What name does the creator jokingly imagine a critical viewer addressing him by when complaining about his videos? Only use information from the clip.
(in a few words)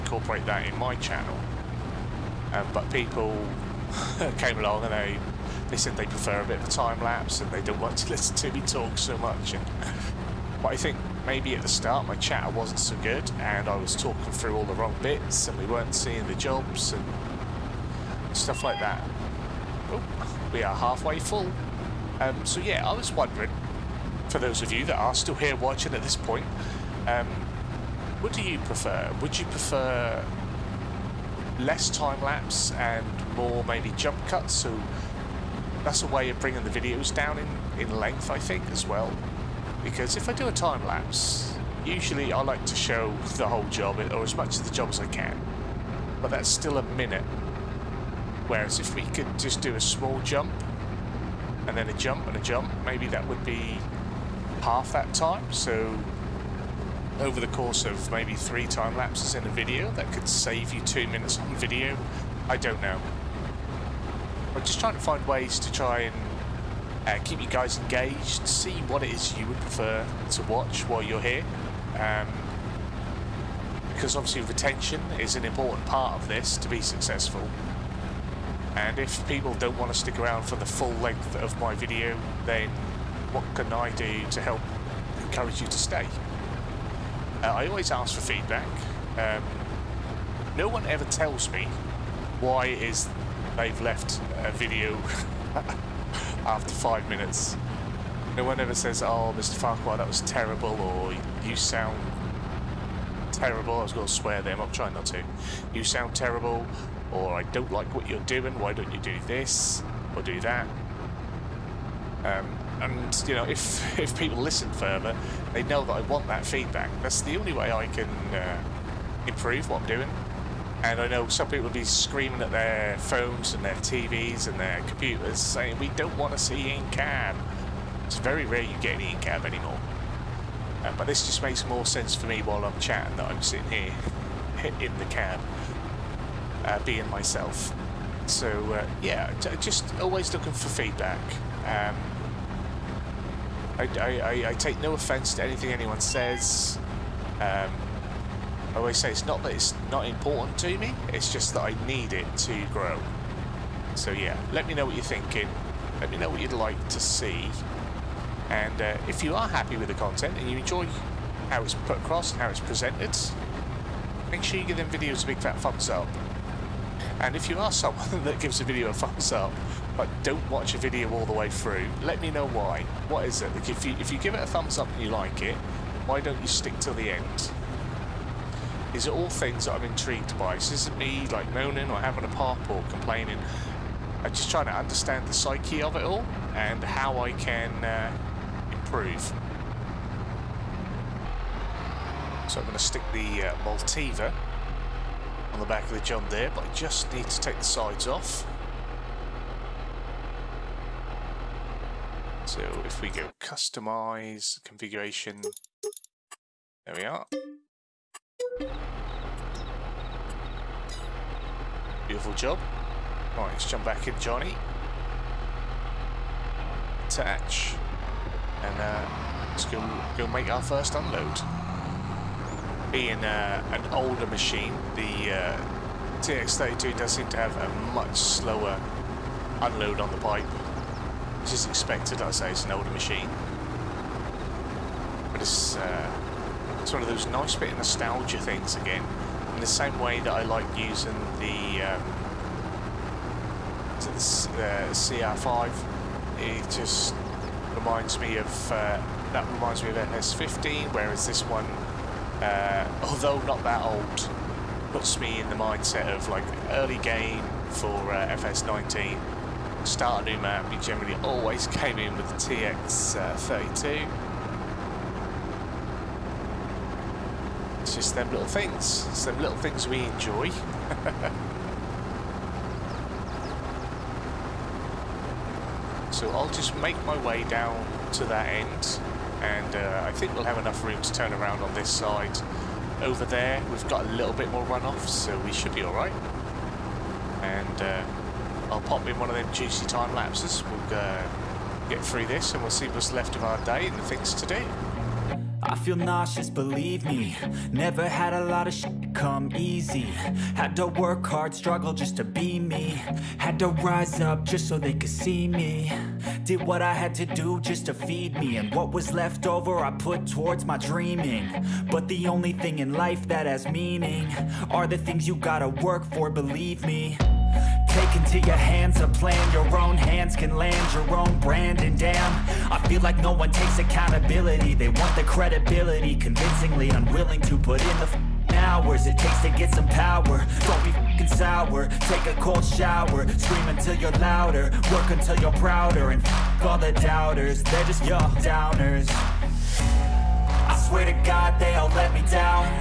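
Mr. Farquar.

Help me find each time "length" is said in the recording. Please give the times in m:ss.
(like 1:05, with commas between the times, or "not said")
0:37, 1:20.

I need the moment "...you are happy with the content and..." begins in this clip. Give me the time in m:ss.
2:39.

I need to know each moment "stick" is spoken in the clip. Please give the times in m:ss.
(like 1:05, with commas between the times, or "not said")
1:19, 2:56, 3:12.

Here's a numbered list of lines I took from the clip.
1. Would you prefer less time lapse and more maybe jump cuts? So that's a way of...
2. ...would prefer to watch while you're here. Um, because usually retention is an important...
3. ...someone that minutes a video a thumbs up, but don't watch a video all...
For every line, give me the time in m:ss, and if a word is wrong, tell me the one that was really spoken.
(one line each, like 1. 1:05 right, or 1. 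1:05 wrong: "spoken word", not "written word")
1. 0:29 right
2. 1:09 wrong: "obviously", not "usually"
3. 2:47 wrong: "gives", not "minutes".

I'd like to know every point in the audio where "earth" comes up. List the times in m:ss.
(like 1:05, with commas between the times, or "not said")
not said.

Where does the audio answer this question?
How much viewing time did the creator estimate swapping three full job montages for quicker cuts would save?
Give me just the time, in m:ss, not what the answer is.
1:00.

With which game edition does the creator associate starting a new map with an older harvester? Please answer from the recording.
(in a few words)
FS19.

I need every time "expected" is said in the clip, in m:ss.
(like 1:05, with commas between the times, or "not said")
3:51.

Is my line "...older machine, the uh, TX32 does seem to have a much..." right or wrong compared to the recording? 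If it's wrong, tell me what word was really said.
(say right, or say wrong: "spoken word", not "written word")
right.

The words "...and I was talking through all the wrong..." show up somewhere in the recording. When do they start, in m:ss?
0:13.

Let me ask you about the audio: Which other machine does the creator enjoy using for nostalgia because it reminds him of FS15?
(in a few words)
CR5.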